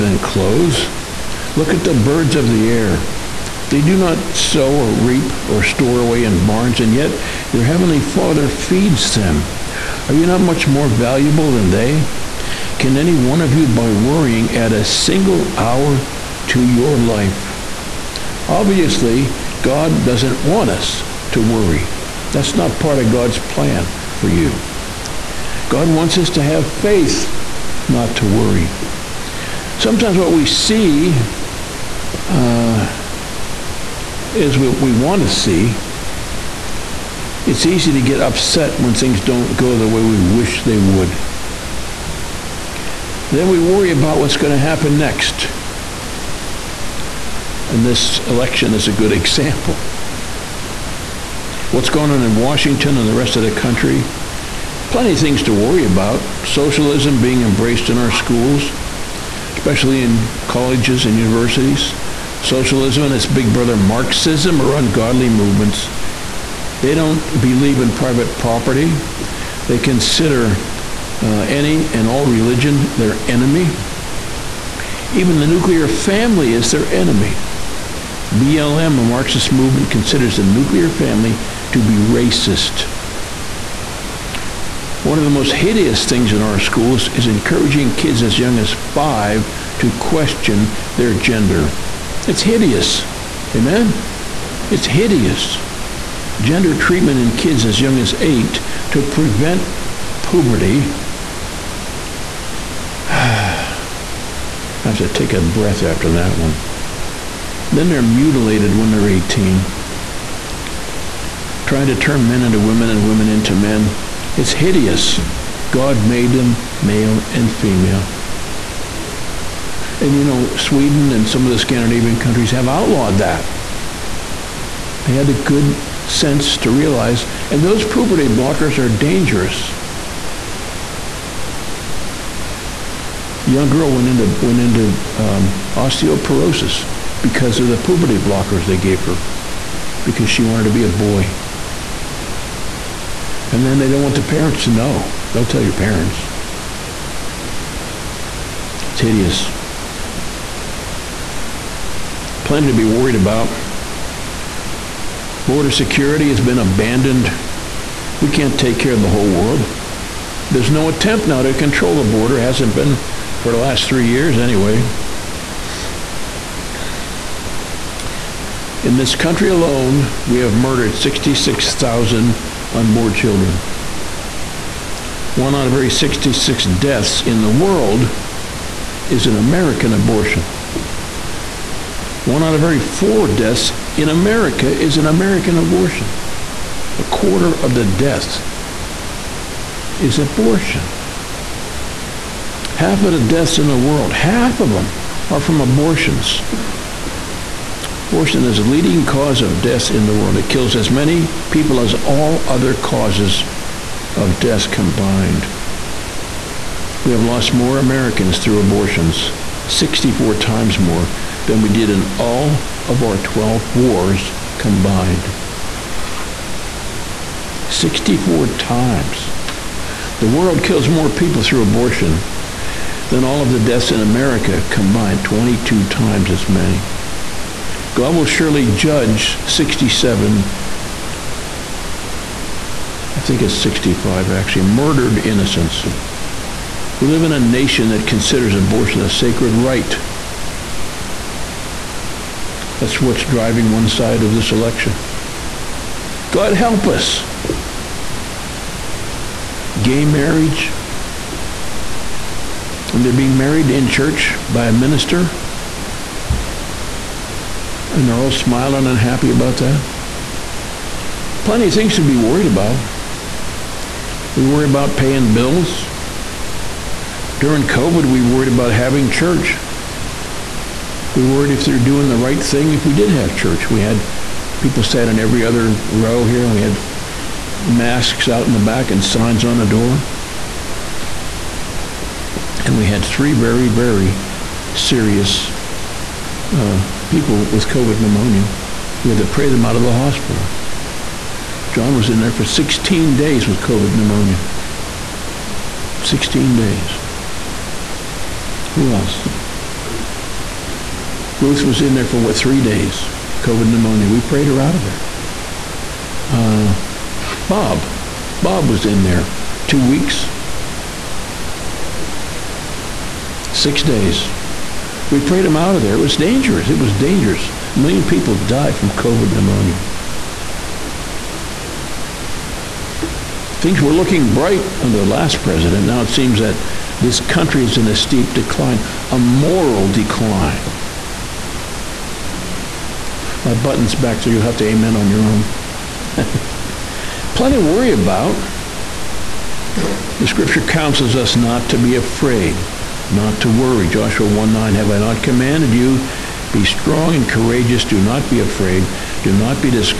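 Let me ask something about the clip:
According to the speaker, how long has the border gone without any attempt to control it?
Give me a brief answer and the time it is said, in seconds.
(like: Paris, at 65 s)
3 years, at 163 s.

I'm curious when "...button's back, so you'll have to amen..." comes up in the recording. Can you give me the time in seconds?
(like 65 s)
333 s.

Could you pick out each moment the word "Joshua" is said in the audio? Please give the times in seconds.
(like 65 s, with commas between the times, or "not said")
343 s.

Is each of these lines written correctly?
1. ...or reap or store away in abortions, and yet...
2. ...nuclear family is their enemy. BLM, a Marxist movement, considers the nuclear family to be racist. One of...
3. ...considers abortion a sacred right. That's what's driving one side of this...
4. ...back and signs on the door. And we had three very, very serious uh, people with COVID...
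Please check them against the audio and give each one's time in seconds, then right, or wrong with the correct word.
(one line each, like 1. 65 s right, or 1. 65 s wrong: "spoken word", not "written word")
1. 4 s wrong: "barns", not "abortions"
2. 75 s right
3. 238 s right
4. 278 s right.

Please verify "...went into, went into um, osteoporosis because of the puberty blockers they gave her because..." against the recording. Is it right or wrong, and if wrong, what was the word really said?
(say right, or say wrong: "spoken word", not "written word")
right.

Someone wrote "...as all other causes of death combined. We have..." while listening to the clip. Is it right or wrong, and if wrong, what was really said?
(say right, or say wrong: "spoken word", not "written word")
right.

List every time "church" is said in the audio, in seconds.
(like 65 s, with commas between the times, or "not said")
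253 s, 269 s, 273 s.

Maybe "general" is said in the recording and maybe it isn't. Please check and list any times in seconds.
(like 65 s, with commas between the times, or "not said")
not said.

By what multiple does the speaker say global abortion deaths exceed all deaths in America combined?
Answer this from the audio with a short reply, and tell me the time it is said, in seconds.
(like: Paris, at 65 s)
22 times, at 225 s.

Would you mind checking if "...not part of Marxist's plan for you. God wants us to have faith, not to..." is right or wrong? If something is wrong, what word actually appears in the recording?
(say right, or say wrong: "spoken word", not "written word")
wrong: "God", not "Marxist".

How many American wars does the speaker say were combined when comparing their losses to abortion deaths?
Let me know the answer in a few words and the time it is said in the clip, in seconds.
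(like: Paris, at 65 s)
12, at 213 s.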